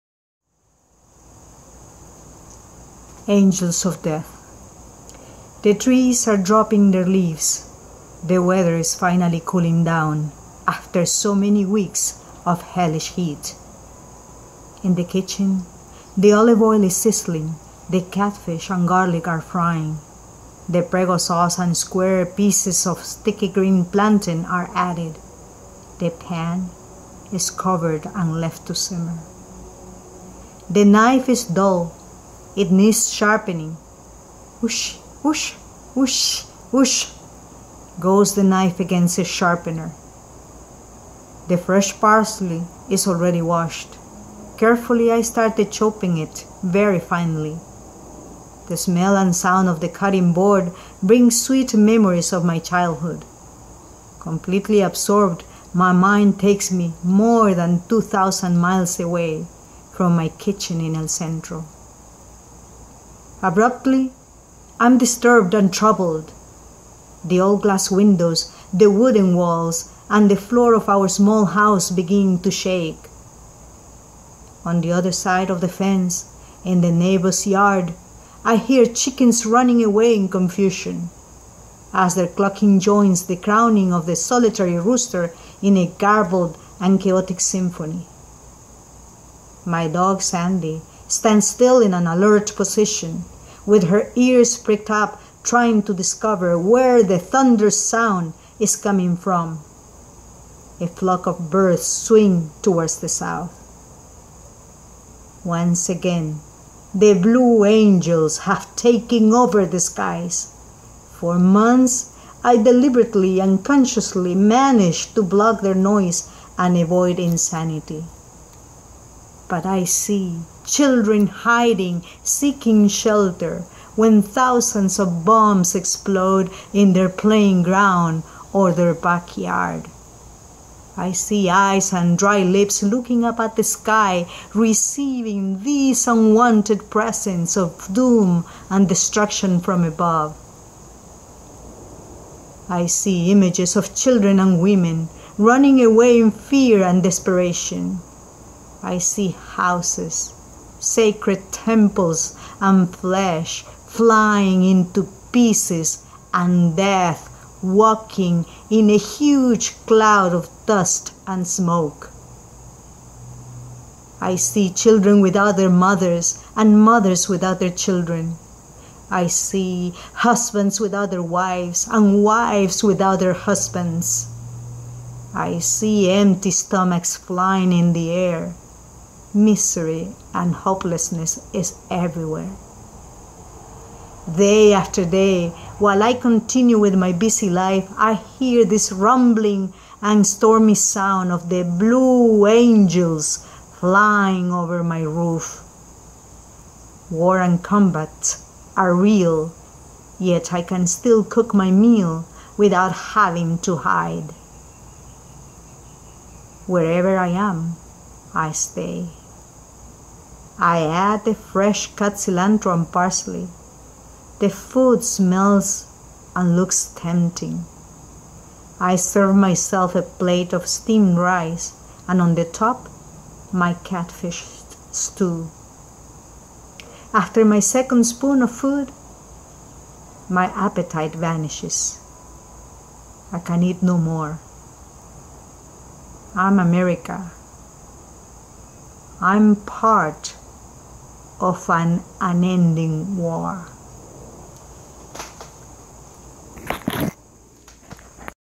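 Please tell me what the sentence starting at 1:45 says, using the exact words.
Once again, the blue angels have taken over the skies.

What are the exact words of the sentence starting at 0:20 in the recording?
The prego sauce and square pieces of sticky green plantain are added.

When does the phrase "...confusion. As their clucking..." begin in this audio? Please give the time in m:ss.
1:20.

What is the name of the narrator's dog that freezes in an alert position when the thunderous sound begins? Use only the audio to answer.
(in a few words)
Sandy.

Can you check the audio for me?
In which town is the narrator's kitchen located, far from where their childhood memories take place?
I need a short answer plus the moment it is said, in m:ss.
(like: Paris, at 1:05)
El Centro, at 1:00.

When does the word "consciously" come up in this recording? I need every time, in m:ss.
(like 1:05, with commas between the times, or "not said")
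1:53.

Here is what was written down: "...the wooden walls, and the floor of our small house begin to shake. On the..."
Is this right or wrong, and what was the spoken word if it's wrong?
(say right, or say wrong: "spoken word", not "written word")
right.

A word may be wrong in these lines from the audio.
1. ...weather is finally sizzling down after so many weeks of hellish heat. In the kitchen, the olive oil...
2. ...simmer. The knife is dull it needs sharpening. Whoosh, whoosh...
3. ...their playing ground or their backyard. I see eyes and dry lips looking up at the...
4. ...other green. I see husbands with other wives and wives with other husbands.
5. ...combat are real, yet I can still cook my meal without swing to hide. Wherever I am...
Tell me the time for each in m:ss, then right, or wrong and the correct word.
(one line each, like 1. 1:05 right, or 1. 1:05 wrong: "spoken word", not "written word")
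1. 0:08 wrong: "cooling", not "sizzling"
2. 0:28 right
3. 2:06 right
4. 2:47 wrong: "children", not "green"
5. 3:17 wrong: "having", not "swing".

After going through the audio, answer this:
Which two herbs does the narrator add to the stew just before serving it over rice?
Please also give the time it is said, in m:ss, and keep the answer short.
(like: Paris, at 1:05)
cilantro and parsley, at 3:32.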